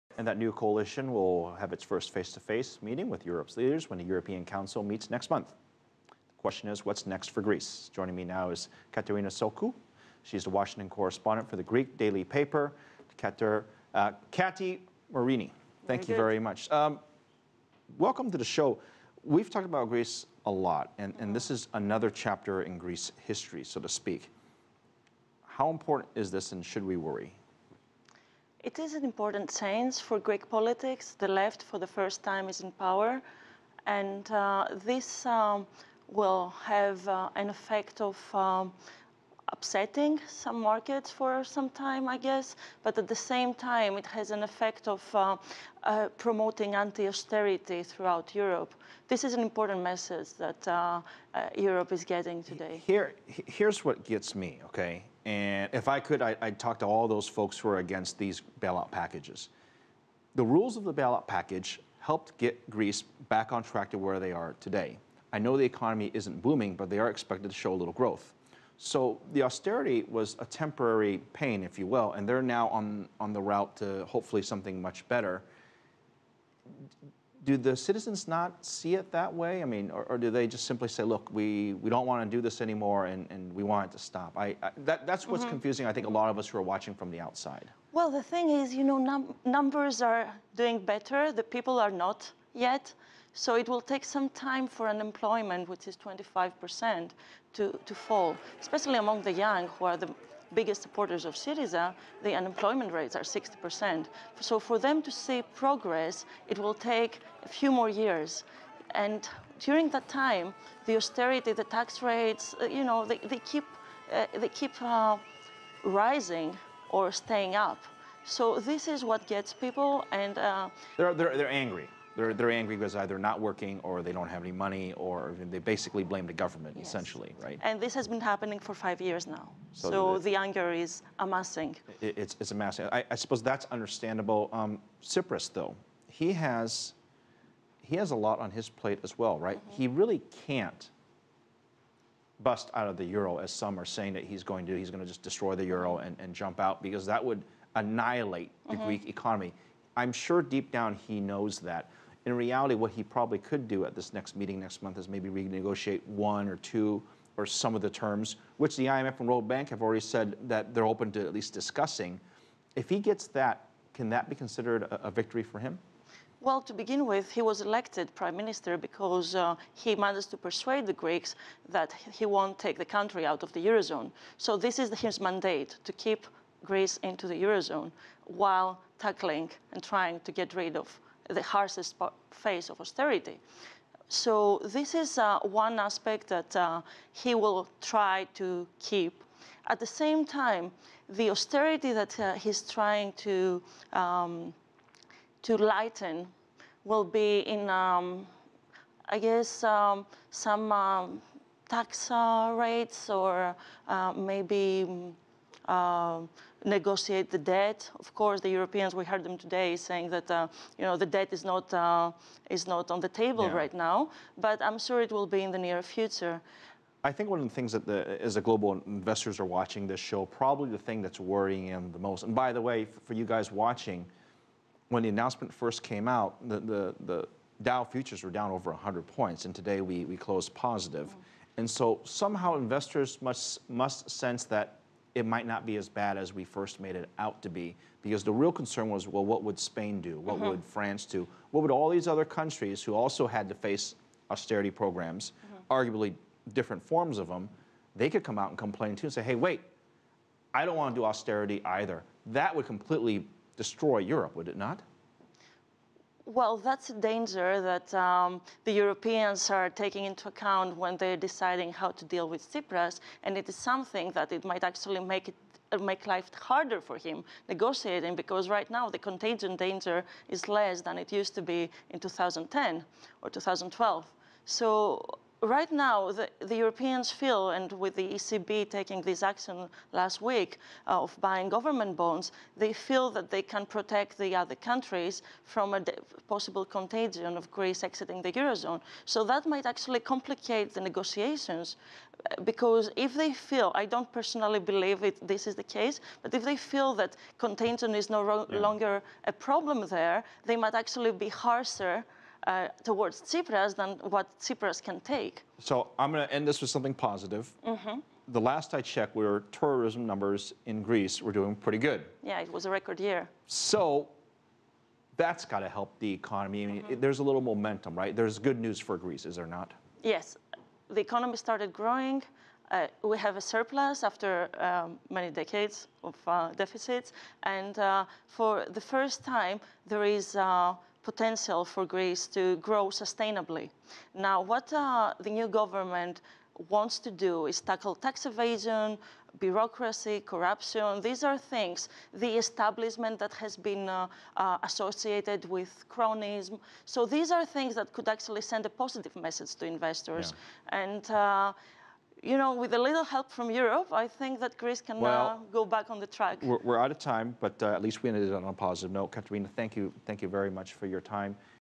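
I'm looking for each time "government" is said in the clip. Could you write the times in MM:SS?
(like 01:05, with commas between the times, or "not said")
02:06, 04:41, 05:35.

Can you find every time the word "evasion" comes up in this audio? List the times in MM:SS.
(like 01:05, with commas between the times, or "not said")
05:38.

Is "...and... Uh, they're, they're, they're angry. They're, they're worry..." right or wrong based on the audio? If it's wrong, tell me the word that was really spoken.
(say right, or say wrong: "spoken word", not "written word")
wrong: "angry", not "worry".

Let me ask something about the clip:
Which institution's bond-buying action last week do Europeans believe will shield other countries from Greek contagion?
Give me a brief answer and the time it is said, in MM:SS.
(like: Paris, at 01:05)
ECB, at 04:38.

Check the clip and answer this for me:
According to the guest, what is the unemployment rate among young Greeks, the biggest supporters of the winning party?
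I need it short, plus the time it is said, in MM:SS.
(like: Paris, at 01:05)
60%, at 01:43.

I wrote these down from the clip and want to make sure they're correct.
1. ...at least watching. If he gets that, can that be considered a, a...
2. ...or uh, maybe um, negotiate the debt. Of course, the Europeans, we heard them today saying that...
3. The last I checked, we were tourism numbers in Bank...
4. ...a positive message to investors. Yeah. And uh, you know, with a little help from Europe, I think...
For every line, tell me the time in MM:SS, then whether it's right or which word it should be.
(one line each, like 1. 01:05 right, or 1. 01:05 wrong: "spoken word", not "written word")
1. 02:41 wrong: "discussing", not "watching"
2. 03:23 right
3. 05:08 wrong: "Greece", not "Bank"
4. 05:48 right.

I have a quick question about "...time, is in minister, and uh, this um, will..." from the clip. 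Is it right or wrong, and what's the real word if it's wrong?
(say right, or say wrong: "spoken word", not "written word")
wrong: "power", not "minister".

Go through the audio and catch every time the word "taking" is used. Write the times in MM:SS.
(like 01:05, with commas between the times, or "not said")
04:19, 04:38.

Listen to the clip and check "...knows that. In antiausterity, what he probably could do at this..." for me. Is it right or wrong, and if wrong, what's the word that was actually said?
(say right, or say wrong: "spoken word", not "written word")
wrong: "reality", not "antiausterity".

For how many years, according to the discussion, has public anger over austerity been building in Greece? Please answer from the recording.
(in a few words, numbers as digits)
5.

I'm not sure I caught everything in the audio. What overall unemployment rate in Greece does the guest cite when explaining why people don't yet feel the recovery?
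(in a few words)
25%.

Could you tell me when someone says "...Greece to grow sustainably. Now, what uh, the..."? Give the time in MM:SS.
05:31.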